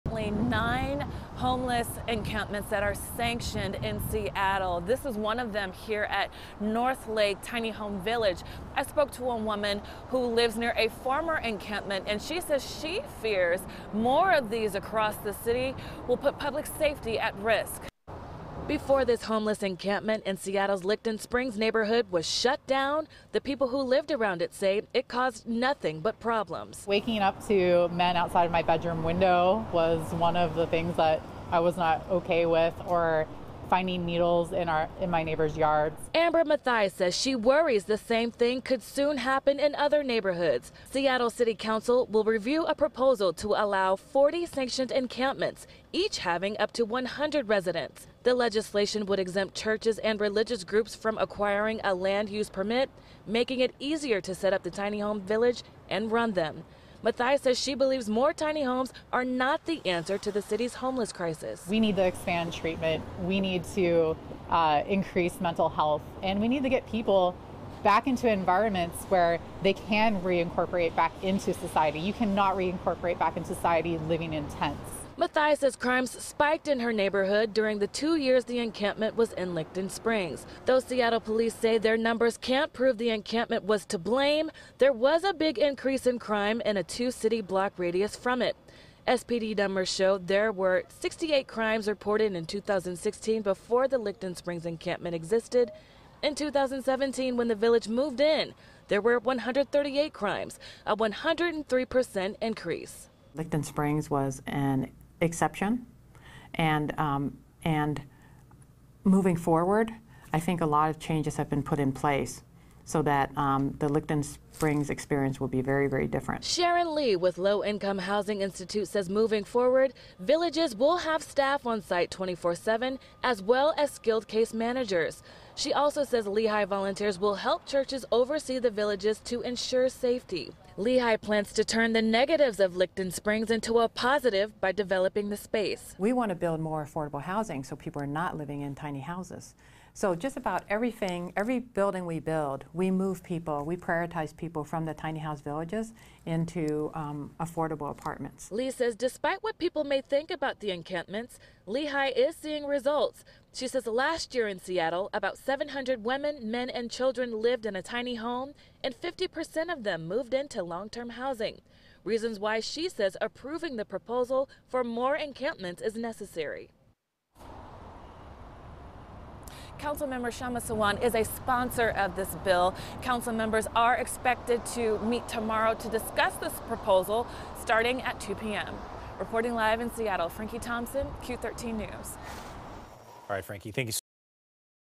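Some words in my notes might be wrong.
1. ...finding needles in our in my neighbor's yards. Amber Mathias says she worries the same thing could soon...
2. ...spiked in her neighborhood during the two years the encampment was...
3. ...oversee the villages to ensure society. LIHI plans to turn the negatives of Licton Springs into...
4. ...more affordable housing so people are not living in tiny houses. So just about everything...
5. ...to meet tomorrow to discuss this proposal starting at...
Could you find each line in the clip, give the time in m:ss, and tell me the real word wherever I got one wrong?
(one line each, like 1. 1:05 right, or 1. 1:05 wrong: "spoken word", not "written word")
1. 0:33 right
2. 1:16 right
3. 2:08 wrong: "safety", not "society"
4. 2:16 right
5. 2:54 right.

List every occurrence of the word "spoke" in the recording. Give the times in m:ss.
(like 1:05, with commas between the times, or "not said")
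0:08.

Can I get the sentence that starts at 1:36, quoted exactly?
In 2017, when the village moved in, there were 138 crimes, a 103% increase.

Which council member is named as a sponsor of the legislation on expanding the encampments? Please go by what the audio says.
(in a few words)
Kshama Sawant.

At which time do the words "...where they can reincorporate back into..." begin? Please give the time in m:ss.
1:09.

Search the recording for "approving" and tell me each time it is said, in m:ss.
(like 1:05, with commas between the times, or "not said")
2:43.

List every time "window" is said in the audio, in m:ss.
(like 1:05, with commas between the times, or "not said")
0:29.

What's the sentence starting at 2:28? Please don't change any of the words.
Lee says despite what people may think about the encampments, LIHI is seeing results.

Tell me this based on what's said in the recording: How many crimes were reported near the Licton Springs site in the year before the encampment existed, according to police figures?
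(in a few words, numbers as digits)
68.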